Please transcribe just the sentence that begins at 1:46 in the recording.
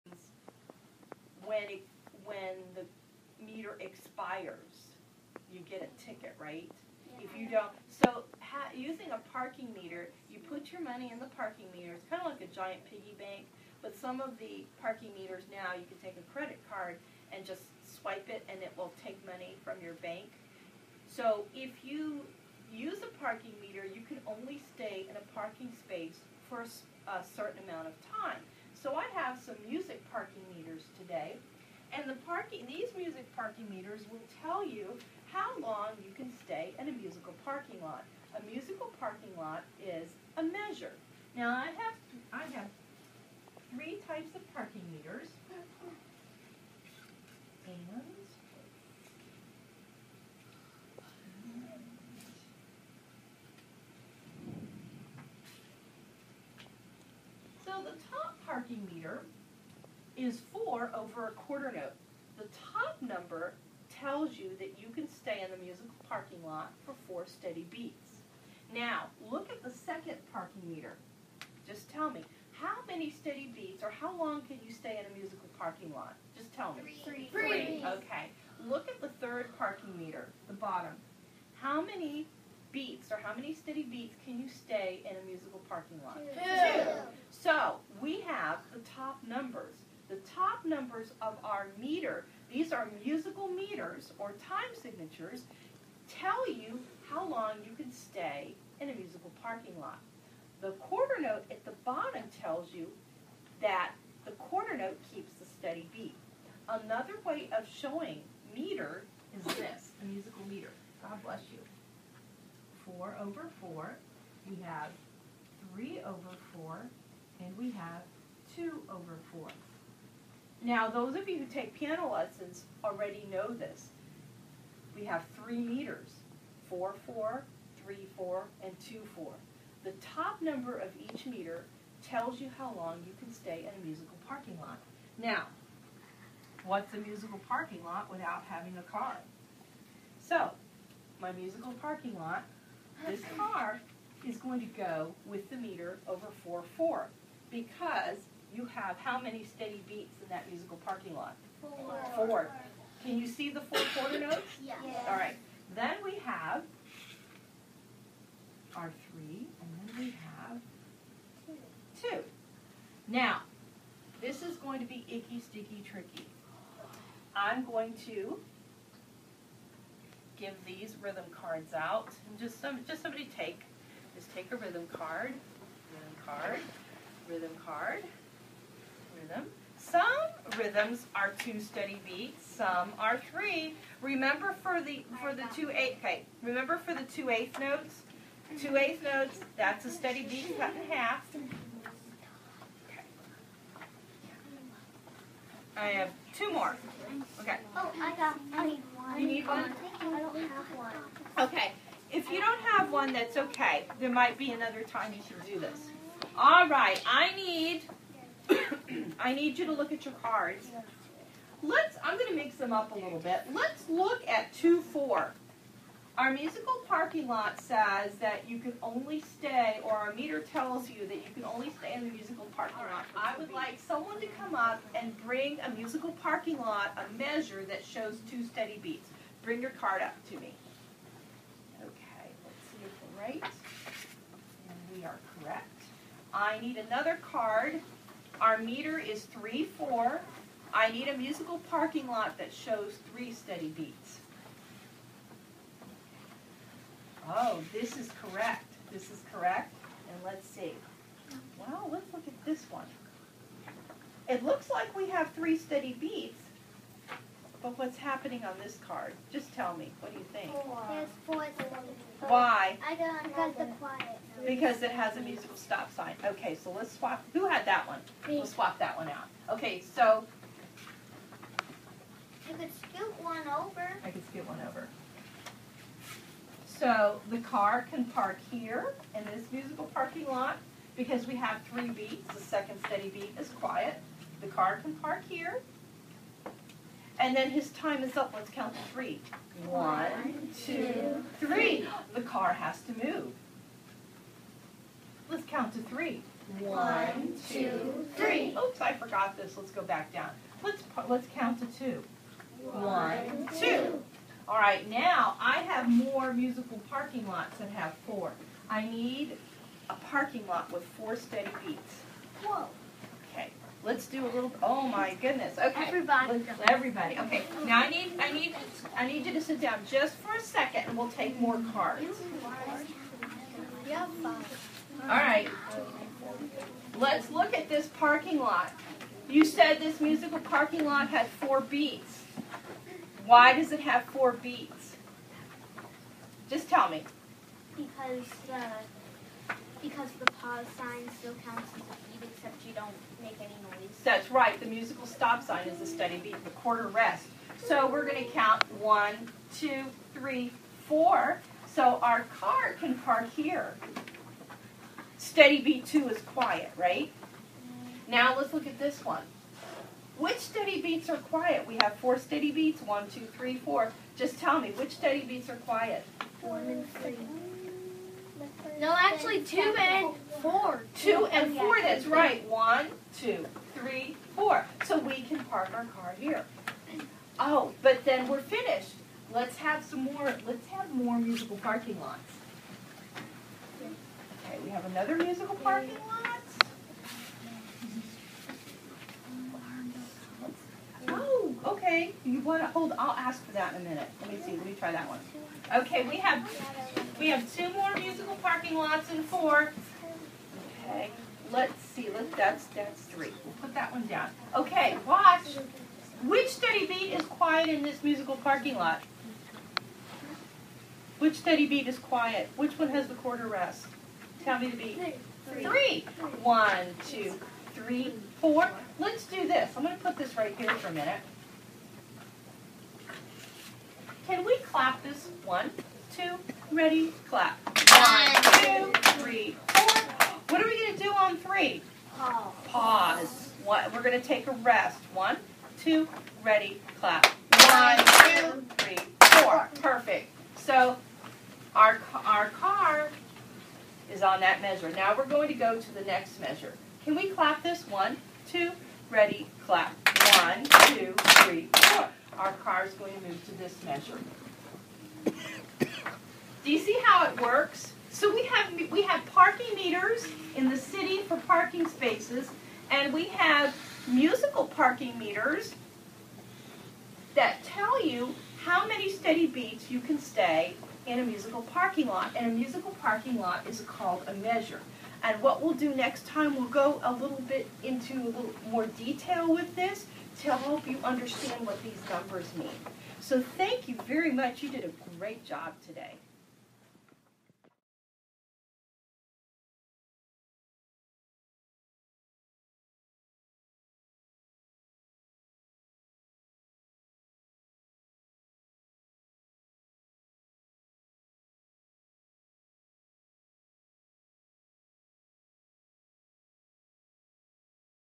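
Another way of showing meter is this, a musical meter.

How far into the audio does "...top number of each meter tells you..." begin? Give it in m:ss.
2:10.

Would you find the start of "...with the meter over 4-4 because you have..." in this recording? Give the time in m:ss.
2:25.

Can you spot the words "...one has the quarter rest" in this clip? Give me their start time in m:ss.
6:52.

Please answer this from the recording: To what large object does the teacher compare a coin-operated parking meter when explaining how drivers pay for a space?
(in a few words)
giant piggy bank.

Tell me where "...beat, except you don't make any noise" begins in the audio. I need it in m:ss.
5:42.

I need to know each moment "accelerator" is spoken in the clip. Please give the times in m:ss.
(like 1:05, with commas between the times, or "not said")
not said.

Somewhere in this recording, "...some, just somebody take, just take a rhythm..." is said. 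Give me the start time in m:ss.
2:52.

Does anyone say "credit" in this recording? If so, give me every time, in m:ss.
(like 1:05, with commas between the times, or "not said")
0:16.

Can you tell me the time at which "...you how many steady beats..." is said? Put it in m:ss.
7:48.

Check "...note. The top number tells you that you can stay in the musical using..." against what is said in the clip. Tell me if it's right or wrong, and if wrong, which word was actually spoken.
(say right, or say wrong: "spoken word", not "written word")
wrong: "parking", not "using".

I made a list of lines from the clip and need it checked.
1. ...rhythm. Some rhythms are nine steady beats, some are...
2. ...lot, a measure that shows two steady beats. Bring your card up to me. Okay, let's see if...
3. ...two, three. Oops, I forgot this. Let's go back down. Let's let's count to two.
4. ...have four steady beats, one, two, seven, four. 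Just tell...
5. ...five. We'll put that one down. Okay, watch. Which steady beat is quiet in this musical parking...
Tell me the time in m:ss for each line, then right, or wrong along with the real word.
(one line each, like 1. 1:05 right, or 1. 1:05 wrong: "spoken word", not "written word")
1. 2:59 wrong: "two", not "nine"
2. 3:46 right
3. 4:57 right
4. 6:01 wrong: "three", not "seven"
5. 6:43 wrong: "three", not "five".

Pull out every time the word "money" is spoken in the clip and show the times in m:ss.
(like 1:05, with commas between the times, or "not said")
0:10, 0:19.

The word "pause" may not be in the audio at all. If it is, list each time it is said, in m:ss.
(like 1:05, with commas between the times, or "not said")
5:40, 7:12.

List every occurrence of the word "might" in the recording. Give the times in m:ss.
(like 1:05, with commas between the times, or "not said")
3:24.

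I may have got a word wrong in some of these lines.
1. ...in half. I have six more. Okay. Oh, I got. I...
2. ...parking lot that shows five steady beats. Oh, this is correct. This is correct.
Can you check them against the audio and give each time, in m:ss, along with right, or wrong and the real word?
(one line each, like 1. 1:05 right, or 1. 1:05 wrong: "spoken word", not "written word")
1. 3:10 wrong: "two", not "six"
2. 4:01 wrong: "three", not "five".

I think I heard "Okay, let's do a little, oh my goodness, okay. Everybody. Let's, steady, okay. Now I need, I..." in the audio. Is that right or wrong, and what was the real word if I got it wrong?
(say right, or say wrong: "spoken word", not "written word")
wrong: "everybody", not "steady".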